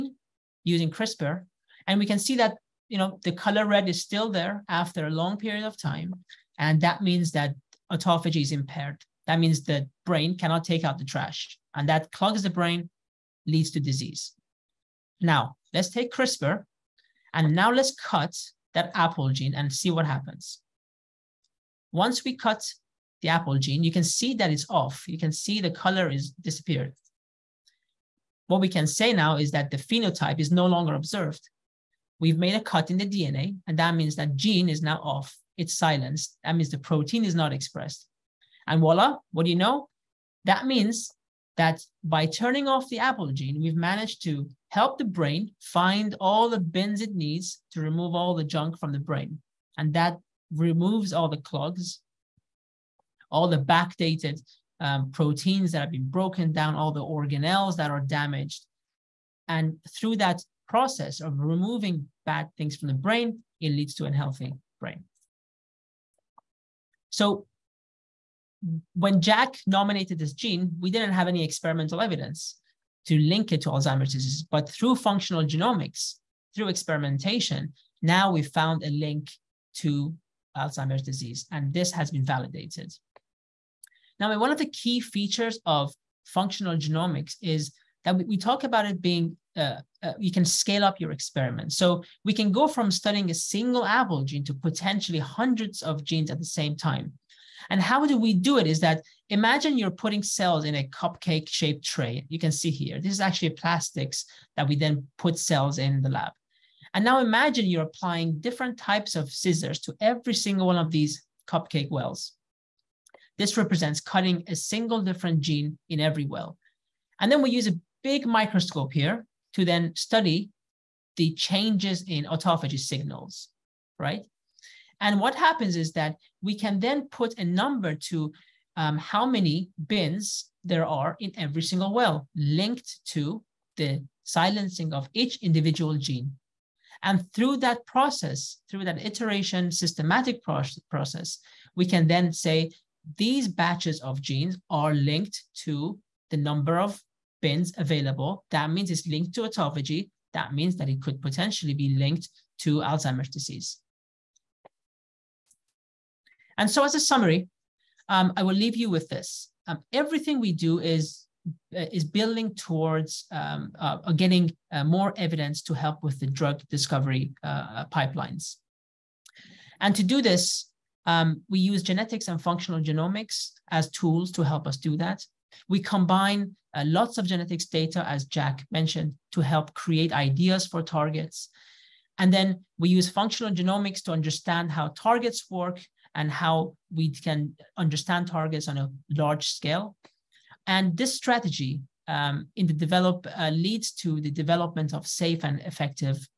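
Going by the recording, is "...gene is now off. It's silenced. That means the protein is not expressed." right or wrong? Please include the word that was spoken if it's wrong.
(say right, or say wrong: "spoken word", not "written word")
right.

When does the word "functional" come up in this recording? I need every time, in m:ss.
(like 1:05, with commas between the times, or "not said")
1:14, 1:26, 2:52, 3:03.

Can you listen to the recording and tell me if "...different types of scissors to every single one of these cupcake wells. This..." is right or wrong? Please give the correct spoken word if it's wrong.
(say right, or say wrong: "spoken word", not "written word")
right.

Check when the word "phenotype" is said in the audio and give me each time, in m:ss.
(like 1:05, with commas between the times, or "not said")
0:29.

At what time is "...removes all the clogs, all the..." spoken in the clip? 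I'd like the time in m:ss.
0:50.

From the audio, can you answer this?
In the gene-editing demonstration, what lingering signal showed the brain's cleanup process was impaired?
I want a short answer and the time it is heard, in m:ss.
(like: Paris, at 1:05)
The color red, at 0:03.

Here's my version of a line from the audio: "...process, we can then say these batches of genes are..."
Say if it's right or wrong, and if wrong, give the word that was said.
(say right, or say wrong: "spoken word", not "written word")
right.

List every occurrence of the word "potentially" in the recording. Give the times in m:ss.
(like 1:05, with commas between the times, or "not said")
1:34, 2:31.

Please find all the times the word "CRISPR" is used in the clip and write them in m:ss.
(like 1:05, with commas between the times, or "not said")
0:00, 0:16.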